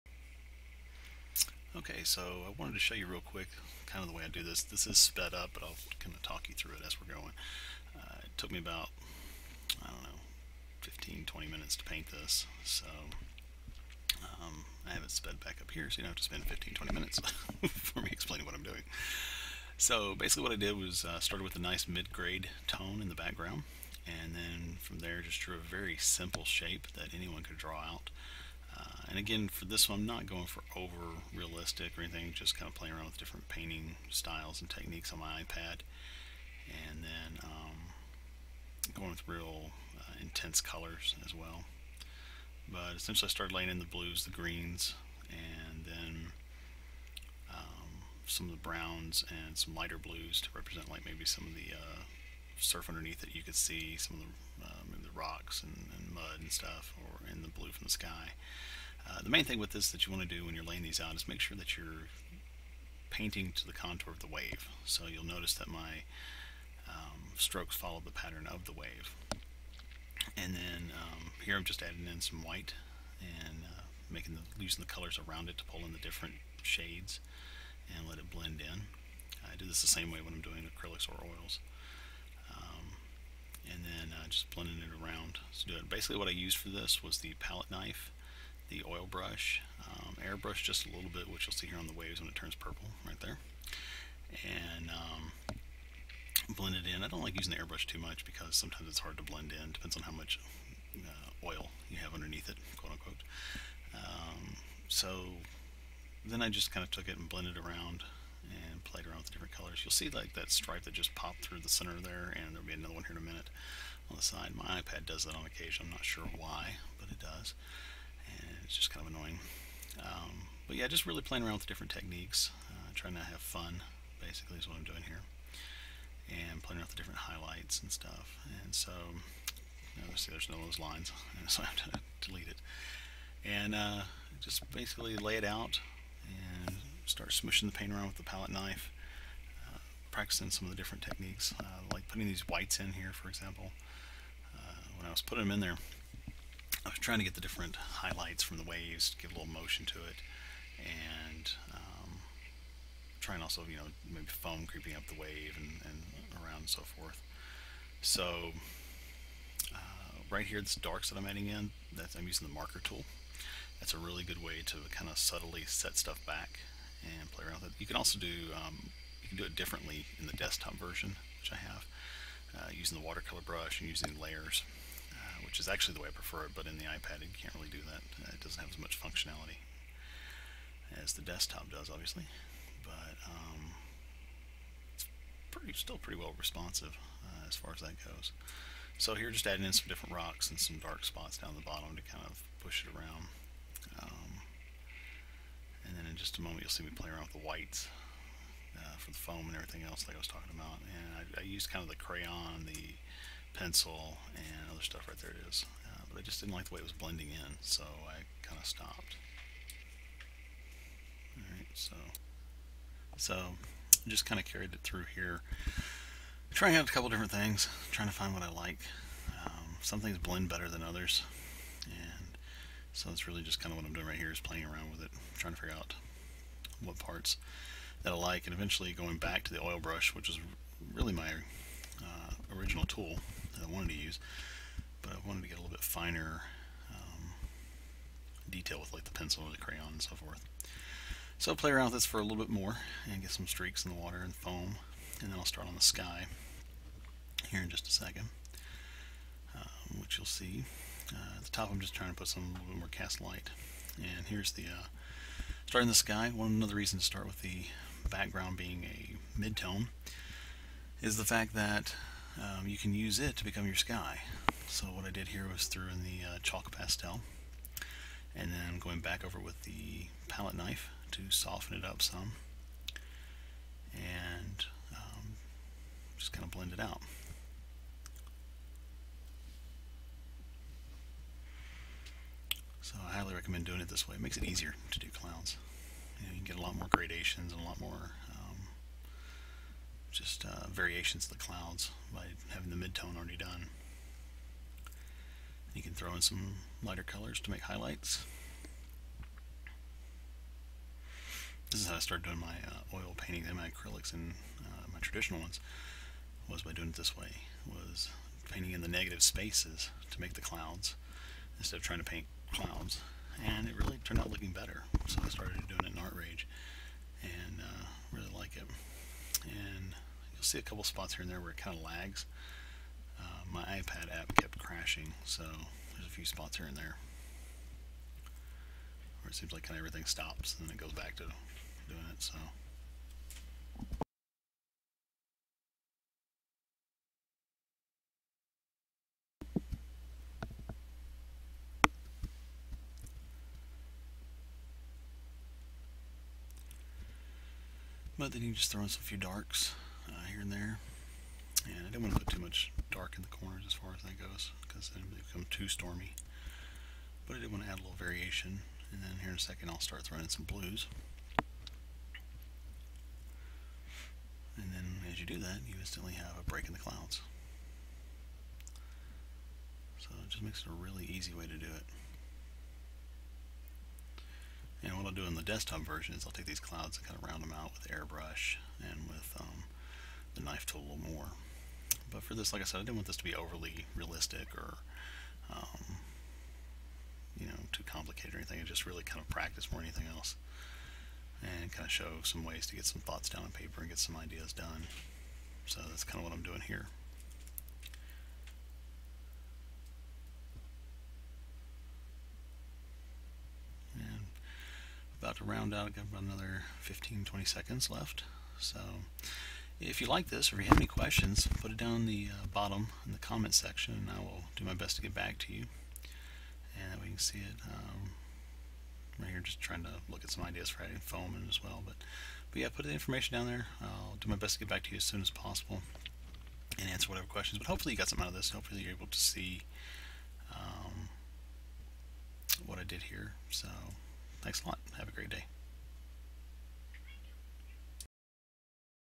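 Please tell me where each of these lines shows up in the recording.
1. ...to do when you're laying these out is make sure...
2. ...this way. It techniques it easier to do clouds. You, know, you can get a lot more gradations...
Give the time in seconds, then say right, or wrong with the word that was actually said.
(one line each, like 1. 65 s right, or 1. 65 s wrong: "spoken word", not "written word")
1. 60 s right
2. 283 s wrong: "makes", not "techniques".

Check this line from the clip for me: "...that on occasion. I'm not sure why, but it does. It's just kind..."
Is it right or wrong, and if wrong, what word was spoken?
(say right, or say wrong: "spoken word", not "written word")
right.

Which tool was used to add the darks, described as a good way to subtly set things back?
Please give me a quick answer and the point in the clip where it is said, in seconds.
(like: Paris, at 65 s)
marker tool, at 162 s.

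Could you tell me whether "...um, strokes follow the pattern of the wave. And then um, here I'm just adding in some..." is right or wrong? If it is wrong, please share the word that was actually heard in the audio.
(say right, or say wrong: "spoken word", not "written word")
right.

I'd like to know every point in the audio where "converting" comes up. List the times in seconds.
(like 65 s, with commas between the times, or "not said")
not said.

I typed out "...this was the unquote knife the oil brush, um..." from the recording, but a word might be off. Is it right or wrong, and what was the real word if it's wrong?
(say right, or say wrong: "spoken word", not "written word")
wrong: "palette", not "unquote".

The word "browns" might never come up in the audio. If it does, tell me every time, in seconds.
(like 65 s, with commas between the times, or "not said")
48 s.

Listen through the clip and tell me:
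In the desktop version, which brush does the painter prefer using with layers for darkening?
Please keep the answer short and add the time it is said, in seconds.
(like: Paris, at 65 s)
watercolor brush, at 173 s.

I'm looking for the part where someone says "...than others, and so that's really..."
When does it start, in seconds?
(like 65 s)
220 s.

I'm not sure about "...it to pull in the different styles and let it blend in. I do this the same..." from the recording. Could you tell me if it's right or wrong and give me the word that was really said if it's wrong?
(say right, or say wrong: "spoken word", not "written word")
wrong: "shades", not "styles".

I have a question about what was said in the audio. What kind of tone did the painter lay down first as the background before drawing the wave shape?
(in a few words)
mid-grade tone.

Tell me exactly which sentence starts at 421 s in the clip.
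But, but yeah, put the information down there.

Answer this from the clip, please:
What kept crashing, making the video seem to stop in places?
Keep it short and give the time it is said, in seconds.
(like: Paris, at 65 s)
iPad app, at 323 s.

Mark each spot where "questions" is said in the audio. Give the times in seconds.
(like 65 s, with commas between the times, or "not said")
410 s, 427 s.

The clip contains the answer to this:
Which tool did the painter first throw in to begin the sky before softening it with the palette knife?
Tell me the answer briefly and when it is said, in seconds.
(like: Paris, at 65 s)
chalk pastel, at 266 s.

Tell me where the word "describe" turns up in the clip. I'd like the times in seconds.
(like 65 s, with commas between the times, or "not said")
not said.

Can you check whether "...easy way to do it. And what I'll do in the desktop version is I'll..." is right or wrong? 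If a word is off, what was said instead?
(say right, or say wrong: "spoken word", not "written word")
right.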